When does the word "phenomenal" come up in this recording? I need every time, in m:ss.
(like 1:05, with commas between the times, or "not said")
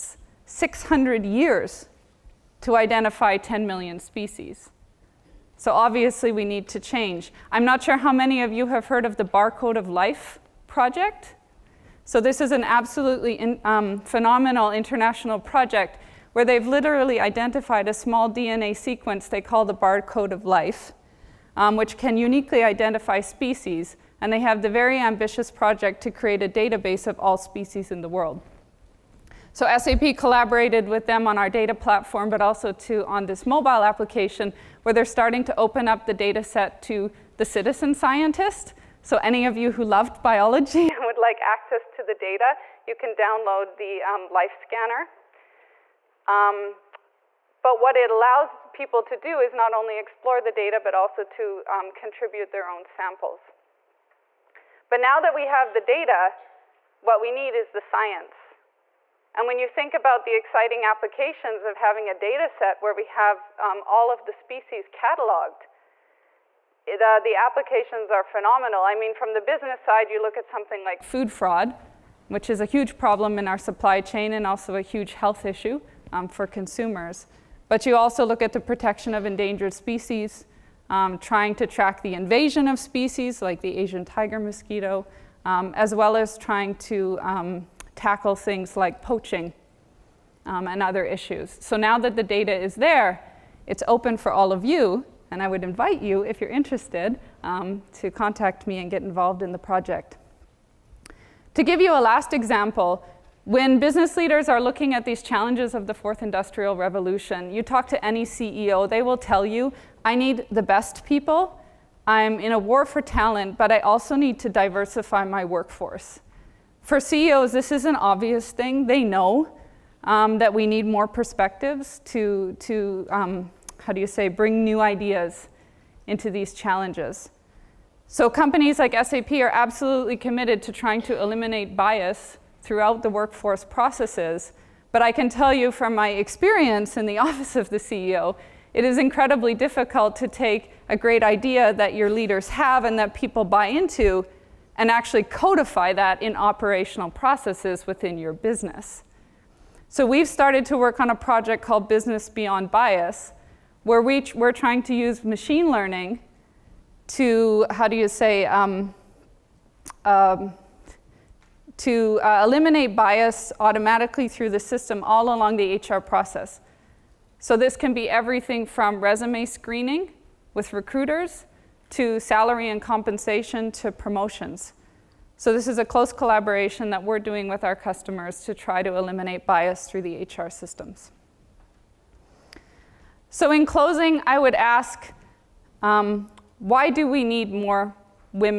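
0:13, 1:08.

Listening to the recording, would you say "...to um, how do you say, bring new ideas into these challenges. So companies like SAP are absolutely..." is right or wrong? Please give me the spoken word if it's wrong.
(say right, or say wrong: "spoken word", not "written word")
right.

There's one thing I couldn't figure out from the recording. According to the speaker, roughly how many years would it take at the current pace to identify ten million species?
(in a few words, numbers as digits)
600.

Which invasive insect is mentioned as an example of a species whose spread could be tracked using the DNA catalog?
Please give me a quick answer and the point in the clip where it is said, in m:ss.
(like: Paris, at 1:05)
Asian tiger mosquito, at 1:23.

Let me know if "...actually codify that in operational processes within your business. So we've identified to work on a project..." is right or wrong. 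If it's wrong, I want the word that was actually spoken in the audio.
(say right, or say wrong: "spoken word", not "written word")
wrong: "started", not "identified".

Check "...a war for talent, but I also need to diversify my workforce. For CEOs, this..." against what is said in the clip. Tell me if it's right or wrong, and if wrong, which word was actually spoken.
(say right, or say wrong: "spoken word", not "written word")
right.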